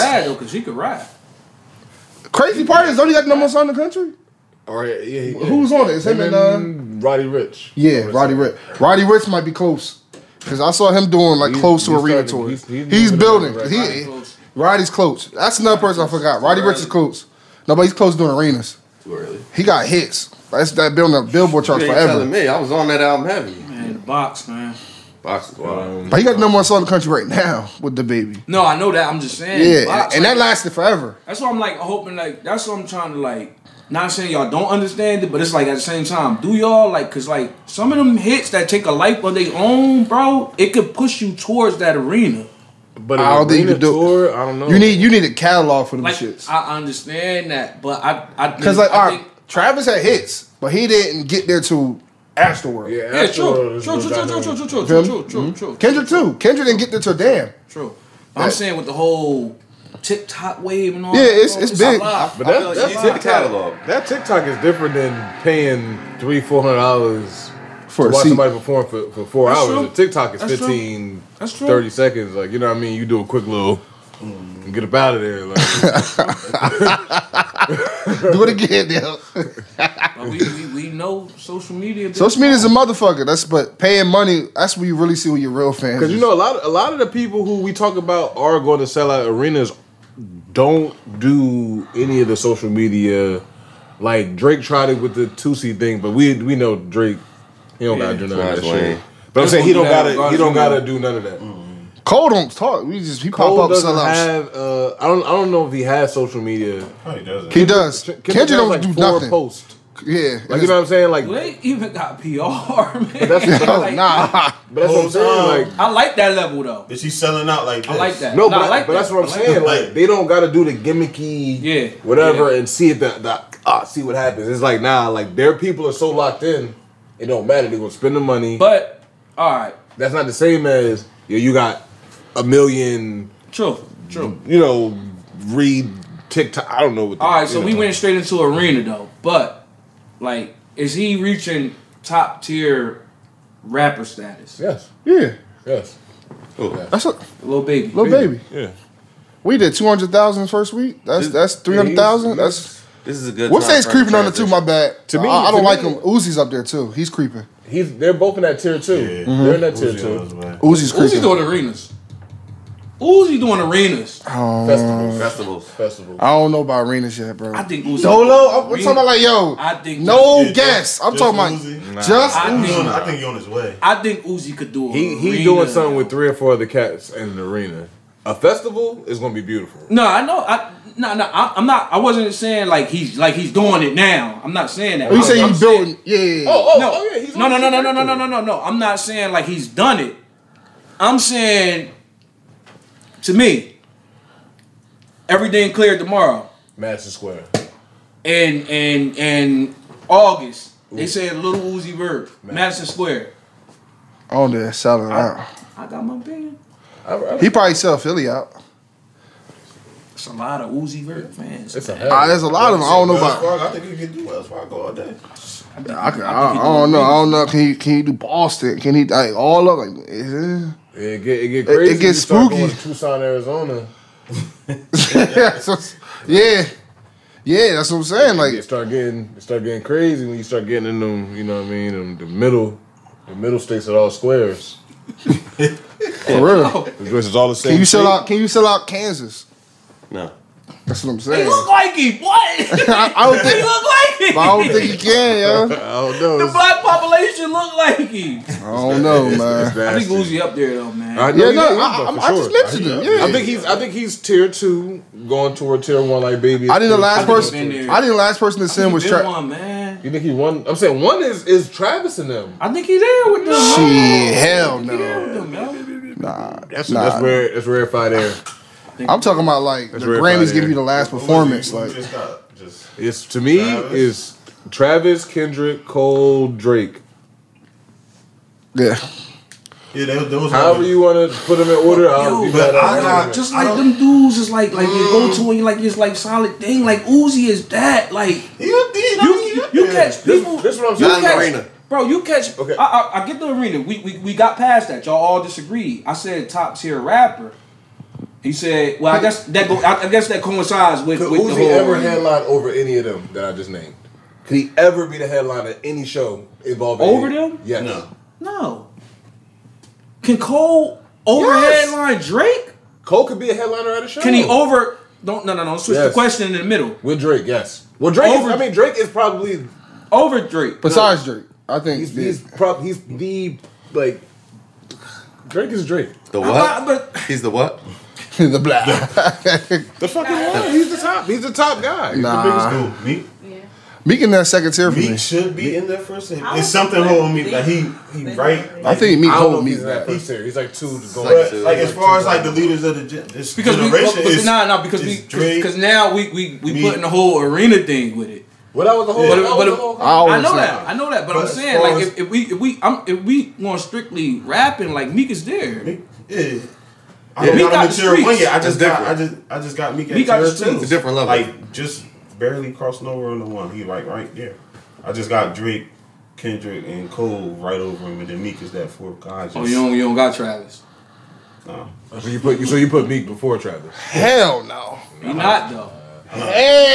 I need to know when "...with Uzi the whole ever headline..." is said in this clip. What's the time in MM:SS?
05:01.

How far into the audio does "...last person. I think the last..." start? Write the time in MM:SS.
04:16.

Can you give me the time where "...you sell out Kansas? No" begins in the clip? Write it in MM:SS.
03:58.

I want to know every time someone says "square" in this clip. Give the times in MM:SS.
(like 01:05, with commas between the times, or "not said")
03:17, 03:22, 03:54.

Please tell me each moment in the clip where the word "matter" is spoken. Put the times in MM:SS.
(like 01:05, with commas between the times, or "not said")
02:07.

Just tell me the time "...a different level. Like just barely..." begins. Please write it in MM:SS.
06:00.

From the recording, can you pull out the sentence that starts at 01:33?
Like Drake tried it with the Toosie thing, but we we know Drake.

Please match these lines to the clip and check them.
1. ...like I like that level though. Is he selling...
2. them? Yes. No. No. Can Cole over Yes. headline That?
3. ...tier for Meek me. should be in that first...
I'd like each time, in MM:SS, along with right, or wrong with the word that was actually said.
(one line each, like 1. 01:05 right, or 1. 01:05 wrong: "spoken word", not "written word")
1. 01:55 right
2. 05:07 wrong: "Drake", not "That"
3. 05:34 right.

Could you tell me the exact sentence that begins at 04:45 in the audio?
and you like it's like solid thing like Uzi is that like You, you, you, you catch people.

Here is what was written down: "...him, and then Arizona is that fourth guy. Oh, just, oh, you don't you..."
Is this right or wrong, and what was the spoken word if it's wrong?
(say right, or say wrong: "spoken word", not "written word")
wrong: "Meek", not "Arizona".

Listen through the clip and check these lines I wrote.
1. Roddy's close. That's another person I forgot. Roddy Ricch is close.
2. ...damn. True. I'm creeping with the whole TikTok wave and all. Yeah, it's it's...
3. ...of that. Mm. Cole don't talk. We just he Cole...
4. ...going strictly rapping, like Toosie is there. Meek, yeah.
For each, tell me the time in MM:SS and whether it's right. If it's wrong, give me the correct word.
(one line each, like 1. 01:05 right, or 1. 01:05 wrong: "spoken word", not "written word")
1. 00:14 right
2. 00:57 wrong: "saying", not "creeping"
3. 01:41 right
4. 05:53 wrong: "Meek", not "Toosie".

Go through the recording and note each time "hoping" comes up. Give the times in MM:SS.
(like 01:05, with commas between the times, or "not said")
00:31.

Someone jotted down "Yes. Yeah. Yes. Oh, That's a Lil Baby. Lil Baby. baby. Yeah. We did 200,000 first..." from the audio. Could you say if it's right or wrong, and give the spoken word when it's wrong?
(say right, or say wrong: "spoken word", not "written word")
right.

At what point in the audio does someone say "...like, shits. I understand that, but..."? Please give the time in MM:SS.
00:46.